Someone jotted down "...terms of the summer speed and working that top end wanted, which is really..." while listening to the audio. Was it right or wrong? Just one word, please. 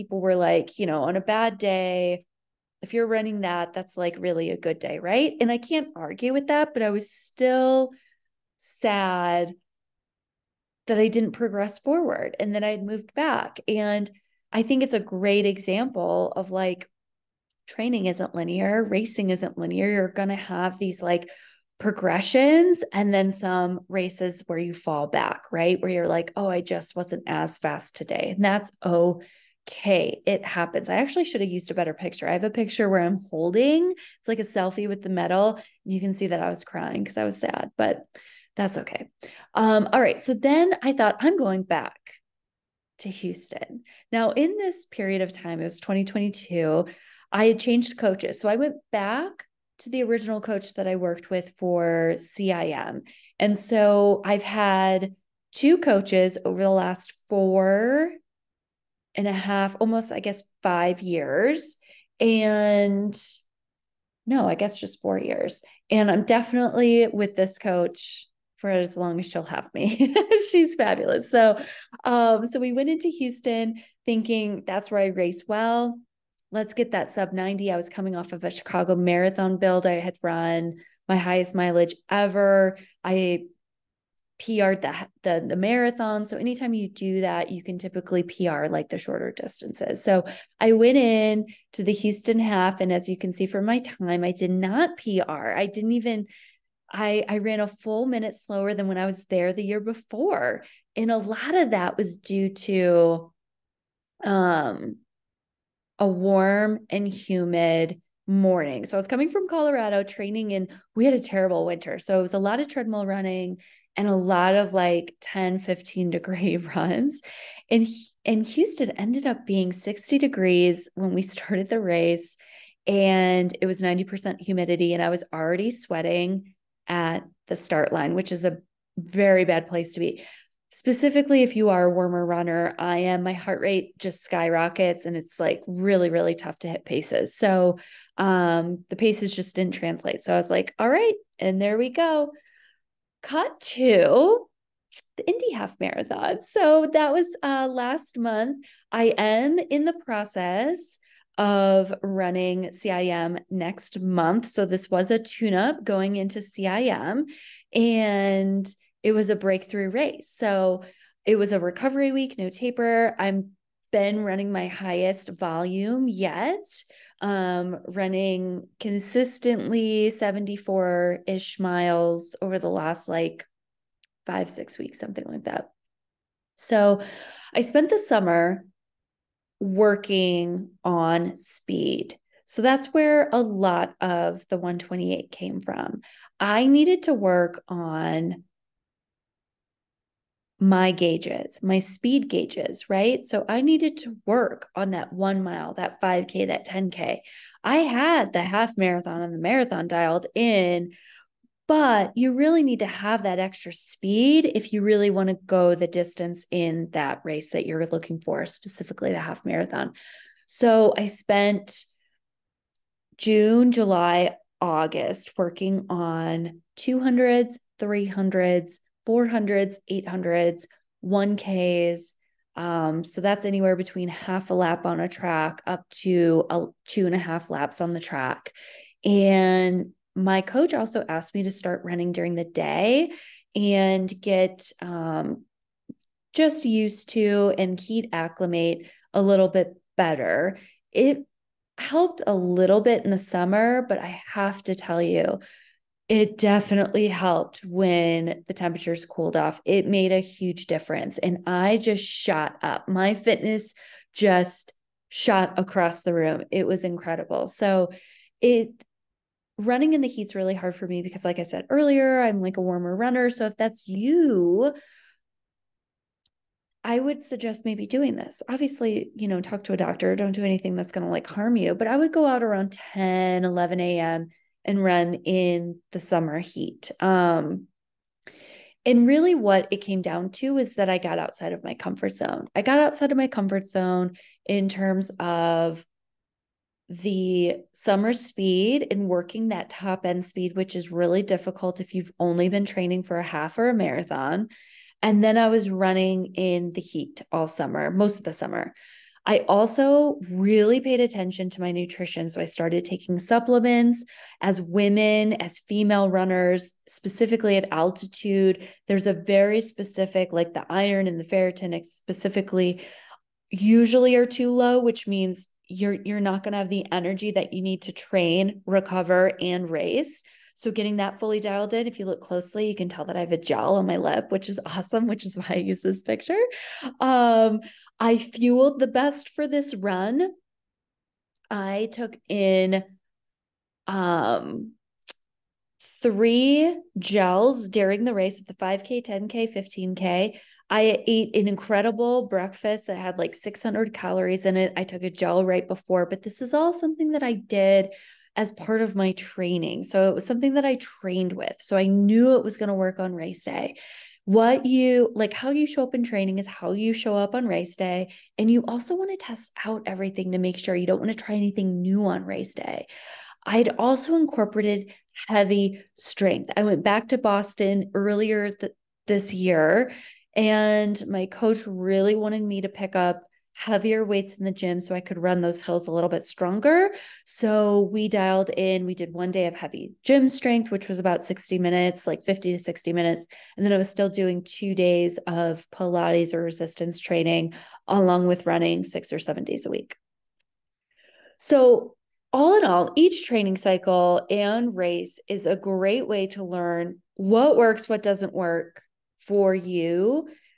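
wrong.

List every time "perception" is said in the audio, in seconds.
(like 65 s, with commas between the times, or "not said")
not said.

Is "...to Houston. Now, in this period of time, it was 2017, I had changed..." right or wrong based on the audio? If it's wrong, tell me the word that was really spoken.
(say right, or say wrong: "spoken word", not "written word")
wrong: "2022", not "2017".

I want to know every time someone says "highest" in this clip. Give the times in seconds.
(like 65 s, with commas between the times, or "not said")
81 s, 164 s.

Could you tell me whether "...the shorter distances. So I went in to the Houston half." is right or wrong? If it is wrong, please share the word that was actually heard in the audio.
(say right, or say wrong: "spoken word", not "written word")
right.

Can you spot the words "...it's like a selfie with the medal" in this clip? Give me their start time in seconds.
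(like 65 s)
33 s.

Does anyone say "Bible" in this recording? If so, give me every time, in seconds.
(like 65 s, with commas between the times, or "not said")
not said.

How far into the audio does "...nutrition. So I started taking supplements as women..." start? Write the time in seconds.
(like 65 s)
301 s.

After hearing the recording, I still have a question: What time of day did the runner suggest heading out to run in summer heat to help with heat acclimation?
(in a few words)
10, 11 a.m.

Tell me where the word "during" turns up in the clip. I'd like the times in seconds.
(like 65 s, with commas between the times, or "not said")
232 s, 337 s.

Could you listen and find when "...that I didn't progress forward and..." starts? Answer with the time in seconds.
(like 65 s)
10 s.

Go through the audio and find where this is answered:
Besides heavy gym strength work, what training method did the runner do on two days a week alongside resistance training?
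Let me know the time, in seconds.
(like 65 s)
385 s.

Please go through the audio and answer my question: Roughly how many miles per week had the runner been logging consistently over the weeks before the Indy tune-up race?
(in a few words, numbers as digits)
74.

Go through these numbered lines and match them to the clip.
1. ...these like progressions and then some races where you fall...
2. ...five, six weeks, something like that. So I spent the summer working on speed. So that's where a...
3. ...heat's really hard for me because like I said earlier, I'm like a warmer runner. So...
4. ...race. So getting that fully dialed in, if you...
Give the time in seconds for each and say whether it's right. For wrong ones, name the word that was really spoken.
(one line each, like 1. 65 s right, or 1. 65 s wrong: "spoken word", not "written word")
1. 20 s right
2. 174 s right
3. 260 s right
4. 319 s right.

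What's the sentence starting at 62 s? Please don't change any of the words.
And no, I guess just four years.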